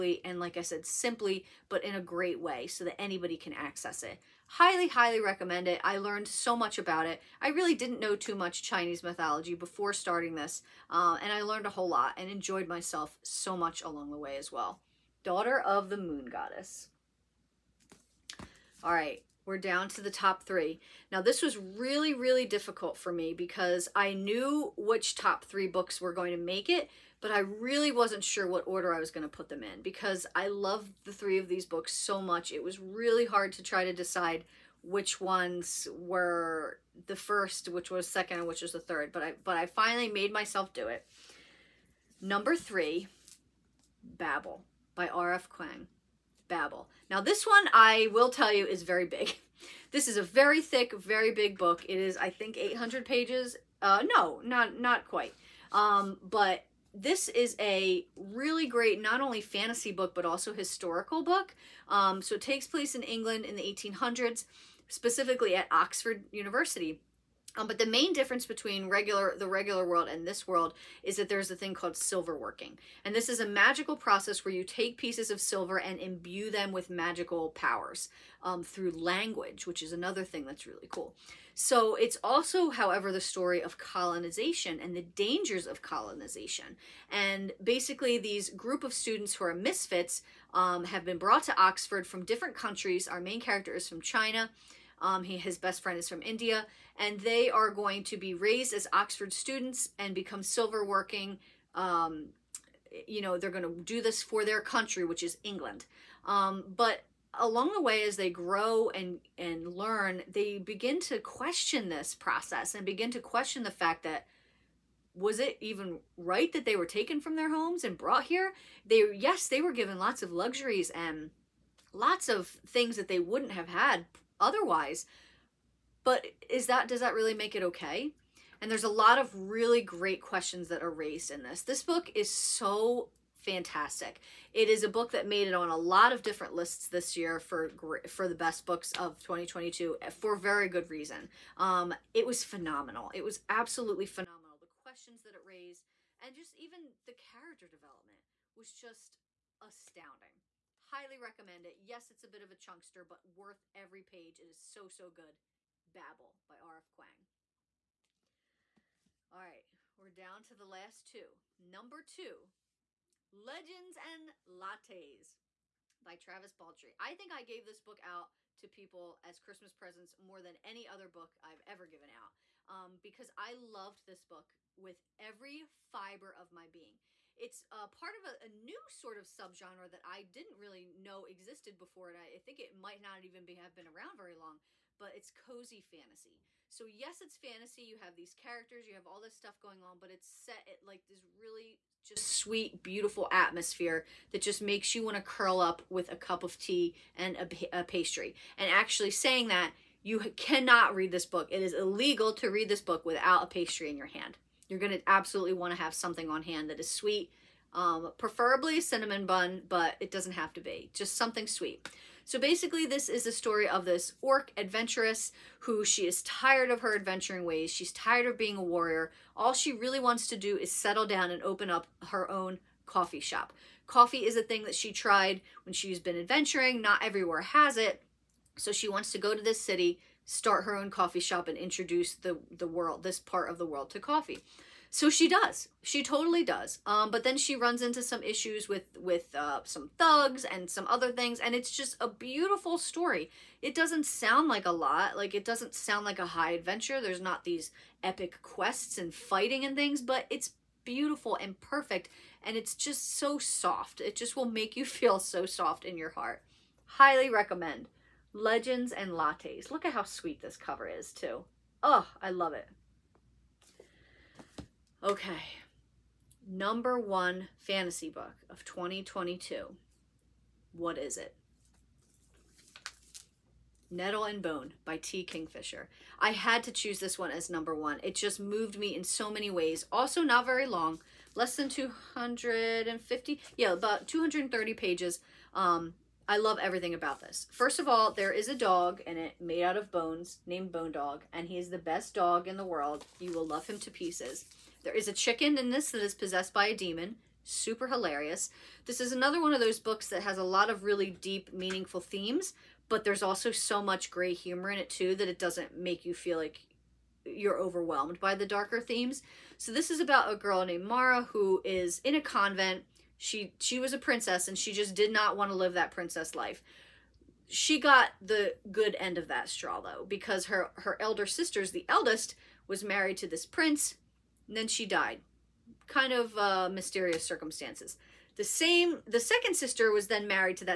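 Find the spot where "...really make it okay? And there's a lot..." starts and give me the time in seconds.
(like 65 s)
127 s.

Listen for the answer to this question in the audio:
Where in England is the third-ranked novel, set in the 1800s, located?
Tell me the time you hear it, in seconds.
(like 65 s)
65 s.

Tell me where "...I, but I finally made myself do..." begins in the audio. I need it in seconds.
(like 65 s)
39 s.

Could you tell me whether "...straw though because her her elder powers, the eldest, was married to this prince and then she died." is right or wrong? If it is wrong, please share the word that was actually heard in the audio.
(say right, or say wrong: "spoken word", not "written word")
wrong: "sisters", not "powers".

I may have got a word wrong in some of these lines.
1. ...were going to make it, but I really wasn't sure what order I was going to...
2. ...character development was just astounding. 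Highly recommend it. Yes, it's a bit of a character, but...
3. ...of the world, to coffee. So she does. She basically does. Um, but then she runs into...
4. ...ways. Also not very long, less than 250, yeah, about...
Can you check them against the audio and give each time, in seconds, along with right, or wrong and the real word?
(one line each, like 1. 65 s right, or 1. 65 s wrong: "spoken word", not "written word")
1. 26 s right
2. 147 s wrong: "chunkster", not "character"
3. 233 s wrong: "totally", not "basically"
4. 279 s right.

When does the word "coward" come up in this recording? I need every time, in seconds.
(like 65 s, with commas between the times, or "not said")
not said.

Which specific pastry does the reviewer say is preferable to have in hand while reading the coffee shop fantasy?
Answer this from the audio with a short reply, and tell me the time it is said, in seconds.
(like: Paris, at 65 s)
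Cinnamon bun, at 208 s.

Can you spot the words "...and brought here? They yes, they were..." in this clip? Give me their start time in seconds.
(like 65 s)
117 s.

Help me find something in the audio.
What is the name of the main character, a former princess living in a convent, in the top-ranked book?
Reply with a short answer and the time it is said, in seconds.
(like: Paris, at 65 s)
Mara, at 310 s.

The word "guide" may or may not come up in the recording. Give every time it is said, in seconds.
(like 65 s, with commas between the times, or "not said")
not said.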